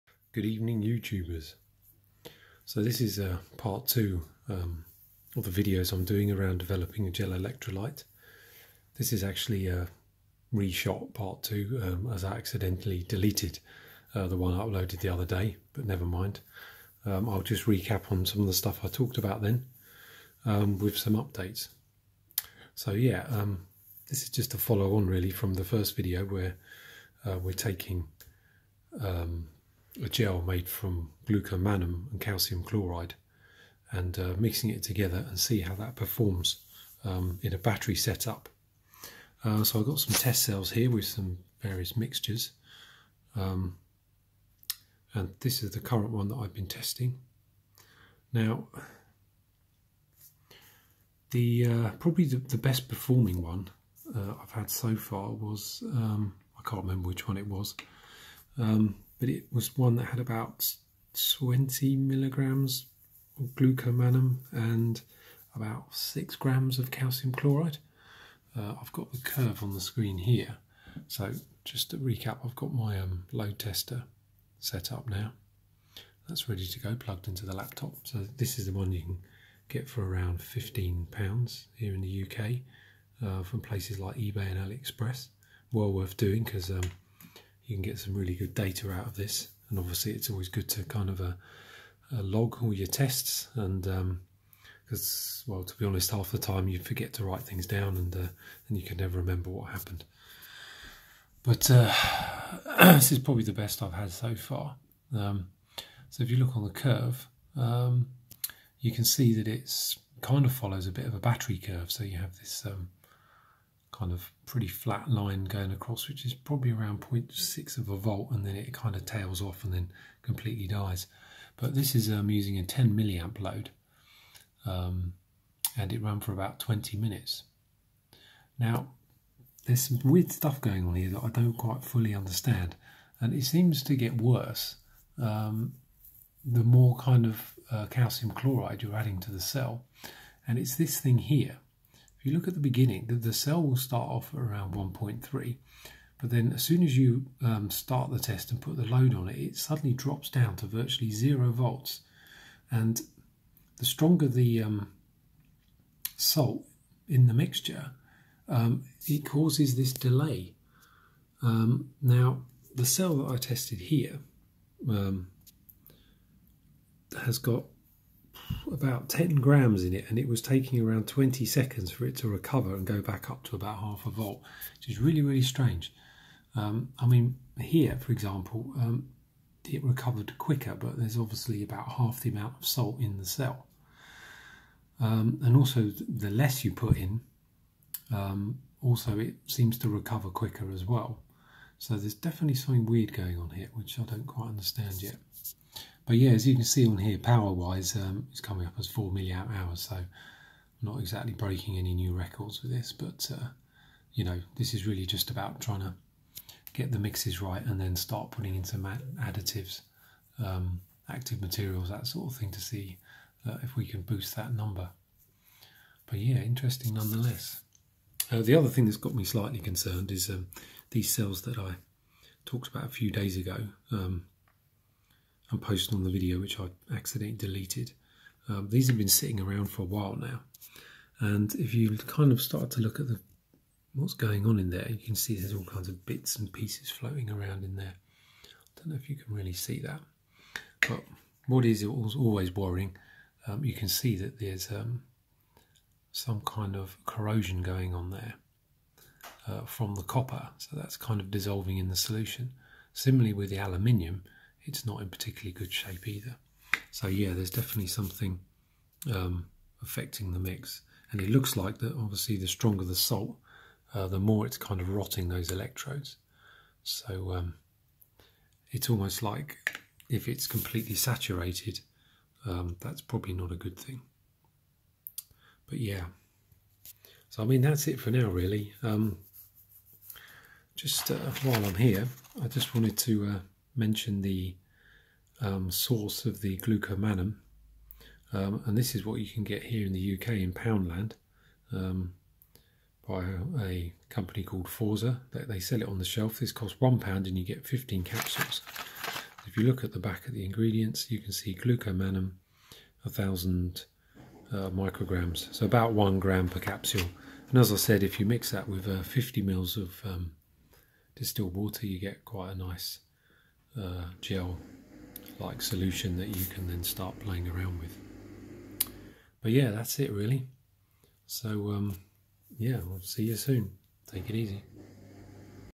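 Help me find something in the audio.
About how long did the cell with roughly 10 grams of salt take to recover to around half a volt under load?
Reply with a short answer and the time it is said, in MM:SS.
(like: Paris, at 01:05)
20 seconds, at 02:51.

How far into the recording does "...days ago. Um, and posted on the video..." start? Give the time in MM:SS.
03:43.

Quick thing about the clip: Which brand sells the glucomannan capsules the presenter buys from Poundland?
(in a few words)
Forza.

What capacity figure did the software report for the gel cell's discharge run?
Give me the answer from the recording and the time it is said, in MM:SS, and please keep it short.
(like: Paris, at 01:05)
4 milliamp hours, at 03:18.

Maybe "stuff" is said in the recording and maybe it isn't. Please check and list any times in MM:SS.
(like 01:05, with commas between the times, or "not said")
00:18, 02:10.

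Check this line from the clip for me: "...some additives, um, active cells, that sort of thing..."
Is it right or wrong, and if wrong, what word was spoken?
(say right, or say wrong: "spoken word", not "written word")
wrong: "materials", not "cells".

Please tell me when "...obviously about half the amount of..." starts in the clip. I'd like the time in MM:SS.
03:01.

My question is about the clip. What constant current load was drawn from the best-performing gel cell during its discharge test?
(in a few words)
10 milliamps.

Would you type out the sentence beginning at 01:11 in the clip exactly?
So just to recap, I've got my um, load tester set up now.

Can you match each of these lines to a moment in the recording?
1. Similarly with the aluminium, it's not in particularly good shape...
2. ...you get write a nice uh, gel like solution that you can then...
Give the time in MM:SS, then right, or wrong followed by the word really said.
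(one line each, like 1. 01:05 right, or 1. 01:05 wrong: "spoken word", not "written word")
1. 04:12 right
2. 05:11 wrong: "quite", not "write".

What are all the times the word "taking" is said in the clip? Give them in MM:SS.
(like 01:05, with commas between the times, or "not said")
00:27, 02:50.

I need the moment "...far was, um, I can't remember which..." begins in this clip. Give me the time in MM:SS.
00:54.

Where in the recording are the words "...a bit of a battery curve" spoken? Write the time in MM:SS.
01:50.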